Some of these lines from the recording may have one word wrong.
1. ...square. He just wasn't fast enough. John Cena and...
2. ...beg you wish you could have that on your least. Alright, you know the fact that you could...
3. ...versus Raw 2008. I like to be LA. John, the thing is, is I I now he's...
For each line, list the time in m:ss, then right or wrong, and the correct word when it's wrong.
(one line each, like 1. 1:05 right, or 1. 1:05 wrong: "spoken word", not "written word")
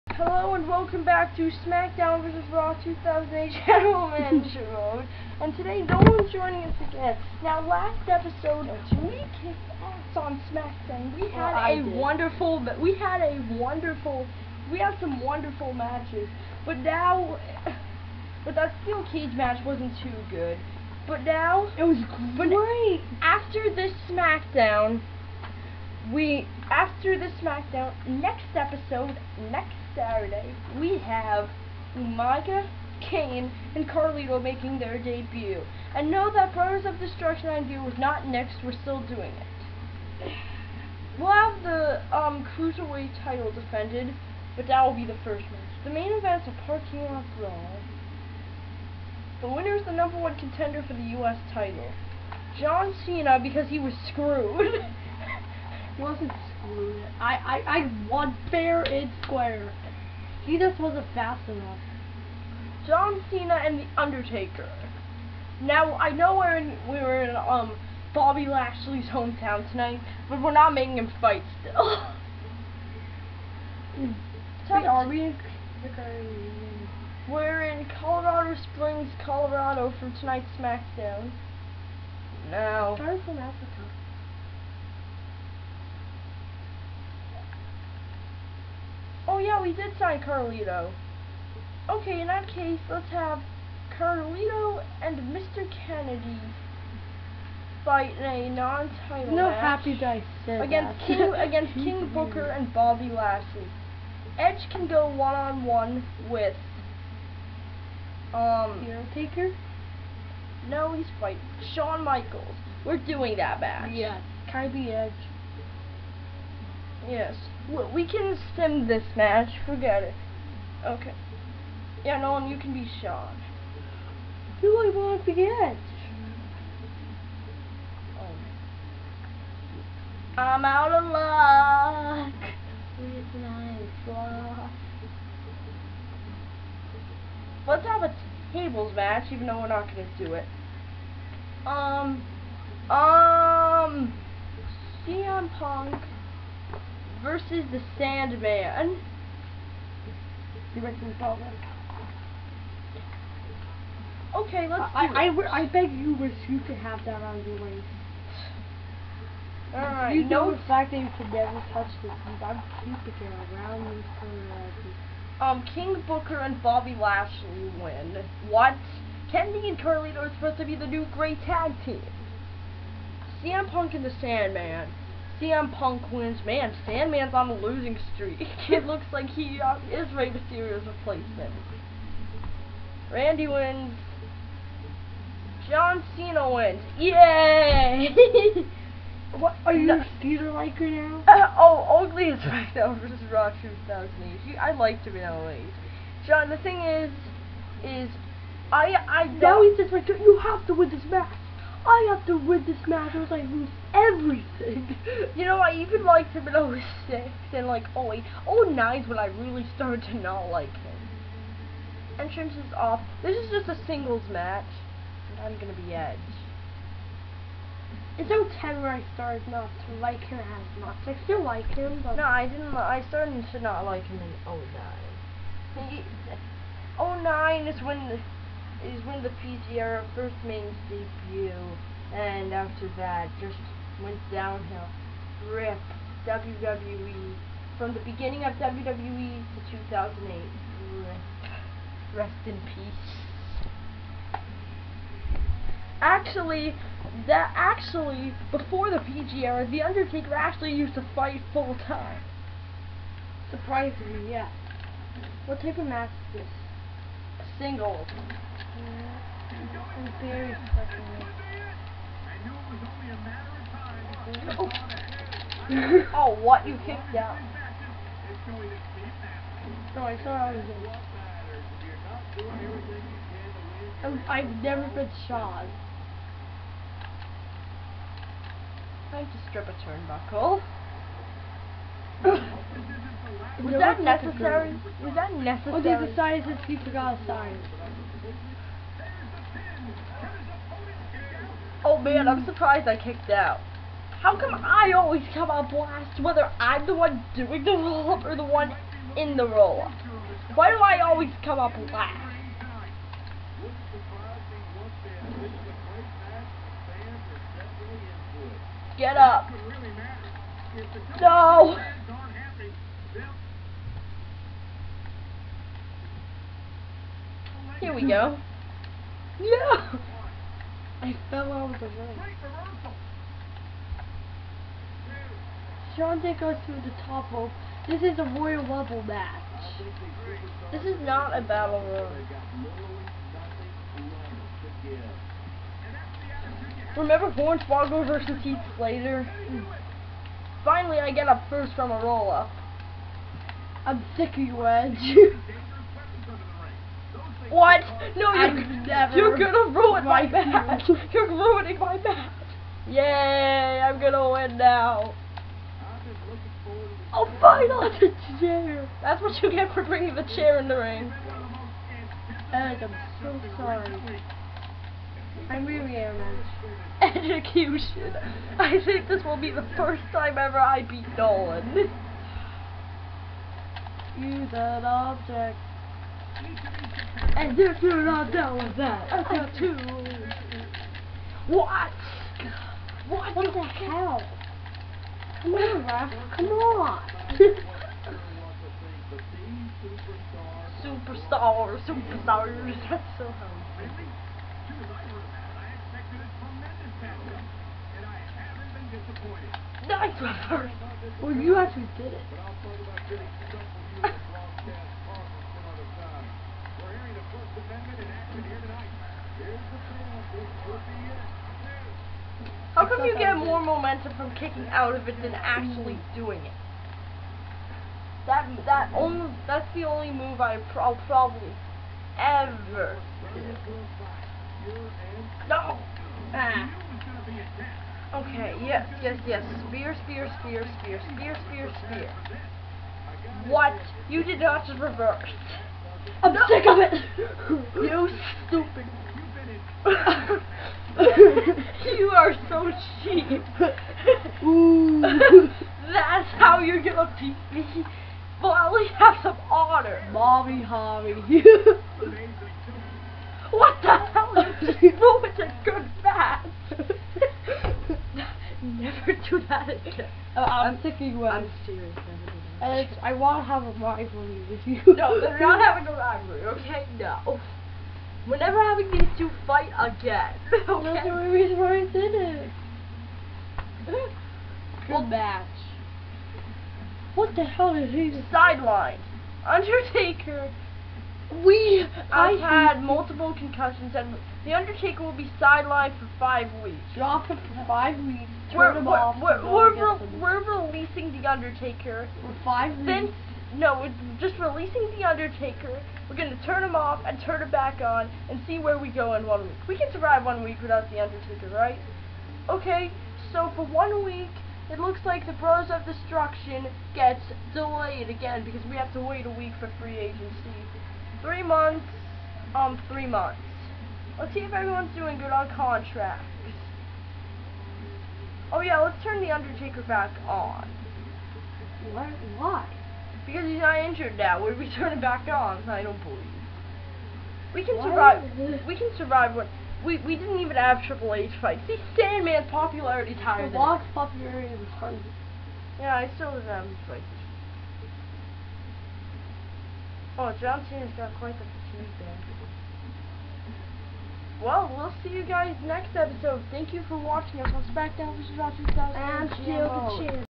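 1. 0:59 right
2. 2:35 wrong: "waist", not "least"
3. 3:13 right.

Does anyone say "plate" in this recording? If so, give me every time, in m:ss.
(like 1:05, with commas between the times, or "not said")
not said.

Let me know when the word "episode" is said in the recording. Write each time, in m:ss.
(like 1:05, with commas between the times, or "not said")
0:08, 0:28, 9:05.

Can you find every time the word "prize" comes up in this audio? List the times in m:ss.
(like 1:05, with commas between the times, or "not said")
not said.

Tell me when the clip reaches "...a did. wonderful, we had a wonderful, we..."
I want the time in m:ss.
0:11.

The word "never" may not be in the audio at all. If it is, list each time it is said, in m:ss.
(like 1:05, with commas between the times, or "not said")
2:41, 4:34, 7:38, 7:48.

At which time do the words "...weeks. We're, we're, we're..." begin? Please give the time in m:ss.
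8:08.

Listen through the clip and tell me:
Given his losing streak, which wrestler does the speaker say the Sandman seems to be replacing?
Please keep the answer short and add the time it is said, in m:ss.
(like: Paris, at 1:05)
Rey Mysterio, at 3:00.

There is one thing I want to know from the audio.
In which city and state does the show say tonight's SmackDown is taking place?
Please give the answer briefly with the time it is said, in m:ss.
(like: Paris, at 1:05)
Colorado Springs, Colorado, at 1:18.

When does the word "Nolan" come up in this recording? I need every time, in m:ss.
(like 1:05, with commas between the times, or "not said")
2:02, 6:11.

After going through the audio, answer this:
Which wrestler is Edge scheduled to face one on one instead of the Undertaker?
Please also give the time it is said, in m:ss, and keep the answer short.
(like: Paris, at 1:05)
Shawn Michaels, at 1:51.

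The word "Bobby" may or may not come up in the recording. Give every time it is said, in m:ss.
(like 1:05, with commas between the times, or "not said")
1:08, 1:42, 2:46.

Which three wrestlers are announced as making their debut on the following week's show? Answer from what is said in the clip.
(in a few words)
Umaga, Kane, and Carlito.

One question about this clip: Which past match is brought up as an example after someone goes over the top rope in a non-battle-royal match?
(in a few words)
Hornswoggle versus Heath Slater.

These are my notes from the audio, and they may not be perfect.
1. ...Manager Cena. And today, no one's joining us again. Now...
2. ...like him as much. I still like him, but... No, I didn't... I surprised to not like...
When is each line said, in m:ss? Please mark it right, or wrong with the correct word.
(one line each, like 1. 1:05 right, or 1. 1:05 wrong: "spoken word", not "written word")
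1. 0:04 wrong: "Mode", not "Cena"
2. 3:39 wrong: "started", not "surprised".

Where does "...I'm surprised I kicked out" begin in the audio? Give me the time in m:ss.
4:52.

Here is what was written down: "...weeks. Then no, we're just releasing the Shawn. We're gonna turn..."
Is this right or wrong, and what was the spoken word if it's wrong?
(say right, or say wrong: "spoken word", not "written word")
wrong: "Undertaker", not "Shawn".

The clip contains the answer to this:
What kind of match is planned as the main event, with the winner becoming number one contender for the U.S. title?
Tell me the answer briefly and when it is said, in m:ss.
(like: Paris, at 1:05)
Parking lot brawl, at 0:46.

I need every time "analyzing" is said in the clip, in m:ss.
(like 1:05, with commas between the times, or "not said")
not said.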